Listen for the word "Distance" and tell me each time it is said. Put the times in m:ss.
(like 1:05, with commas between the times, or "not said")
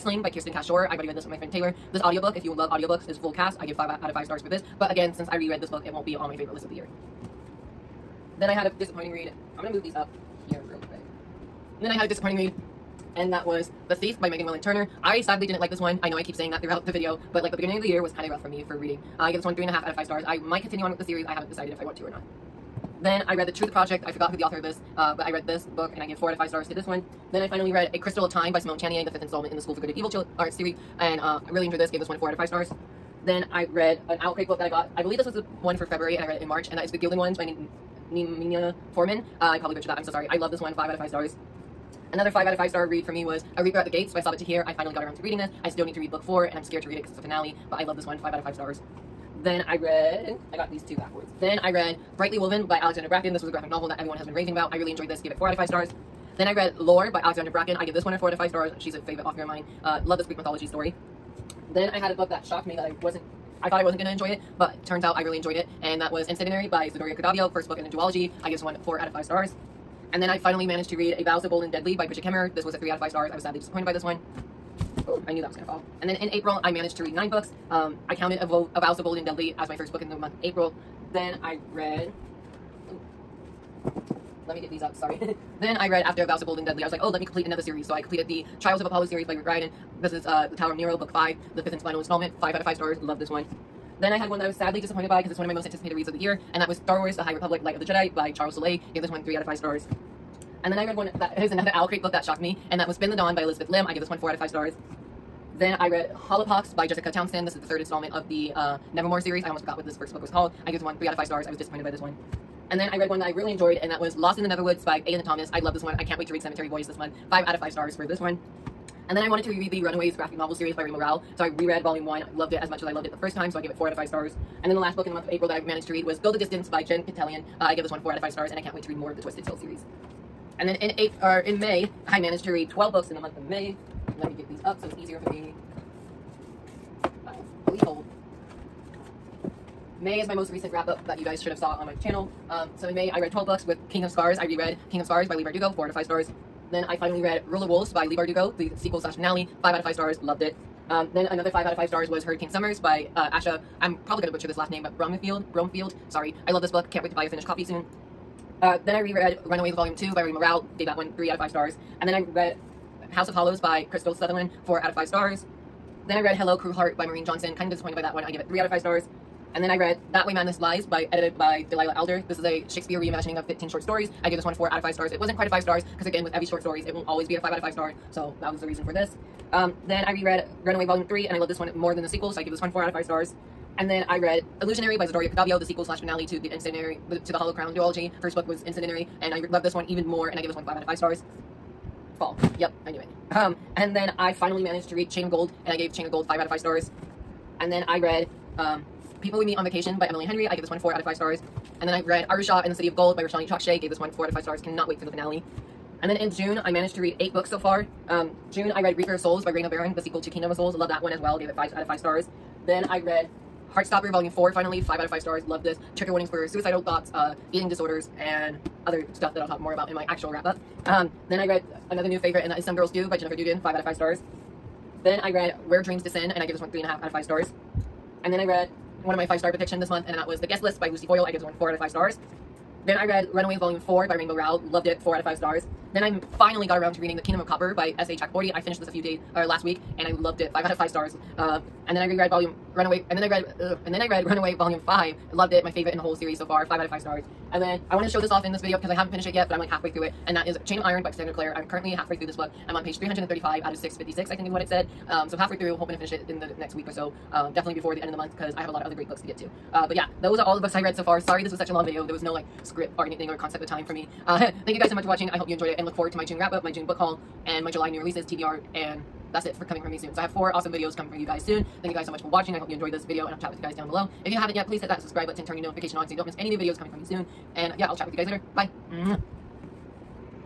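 2:06.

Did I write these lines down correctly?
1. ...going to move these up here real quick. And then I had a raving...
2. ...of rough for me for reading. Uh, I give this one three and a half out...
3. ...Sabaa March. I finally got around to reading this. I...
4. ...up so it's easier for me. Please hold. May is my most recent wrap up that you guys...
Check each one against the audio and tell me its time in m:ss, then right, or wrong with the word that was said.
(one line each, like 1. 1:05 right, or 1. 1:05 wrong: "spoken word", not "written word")
1. 0:09 wrong: "disappointing", not "raving"
2. 0:18 right
3. 0:44 wrong: "Tahir", not "March"
4. 2:14 right.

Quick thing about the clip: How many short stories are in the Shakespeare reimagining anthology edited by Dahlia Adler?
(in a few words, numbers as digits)
15.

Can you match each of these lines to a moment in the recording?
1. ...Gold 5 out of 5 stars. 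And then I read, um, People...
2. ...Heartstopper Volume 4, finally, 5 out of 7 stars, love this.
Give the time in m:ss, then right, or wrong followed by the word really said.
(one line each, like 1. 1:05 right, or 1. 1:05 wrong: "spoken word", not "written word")
1. 3:16 right
2. 3:33 wrong: "5", not "7".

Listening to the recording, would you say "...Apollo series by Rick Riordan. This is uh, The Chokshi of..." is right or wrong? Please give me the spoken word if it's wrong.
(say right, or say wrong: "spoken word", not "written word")
wrong: "Tower", not "Chokshi".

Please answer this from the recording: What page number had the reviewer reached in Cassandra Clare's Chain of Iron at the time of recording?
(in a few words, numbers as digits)
335.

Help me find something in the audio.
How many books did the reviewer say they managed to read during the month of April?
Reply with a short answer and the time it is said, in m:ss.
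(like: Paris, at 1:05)
9, at 1:17.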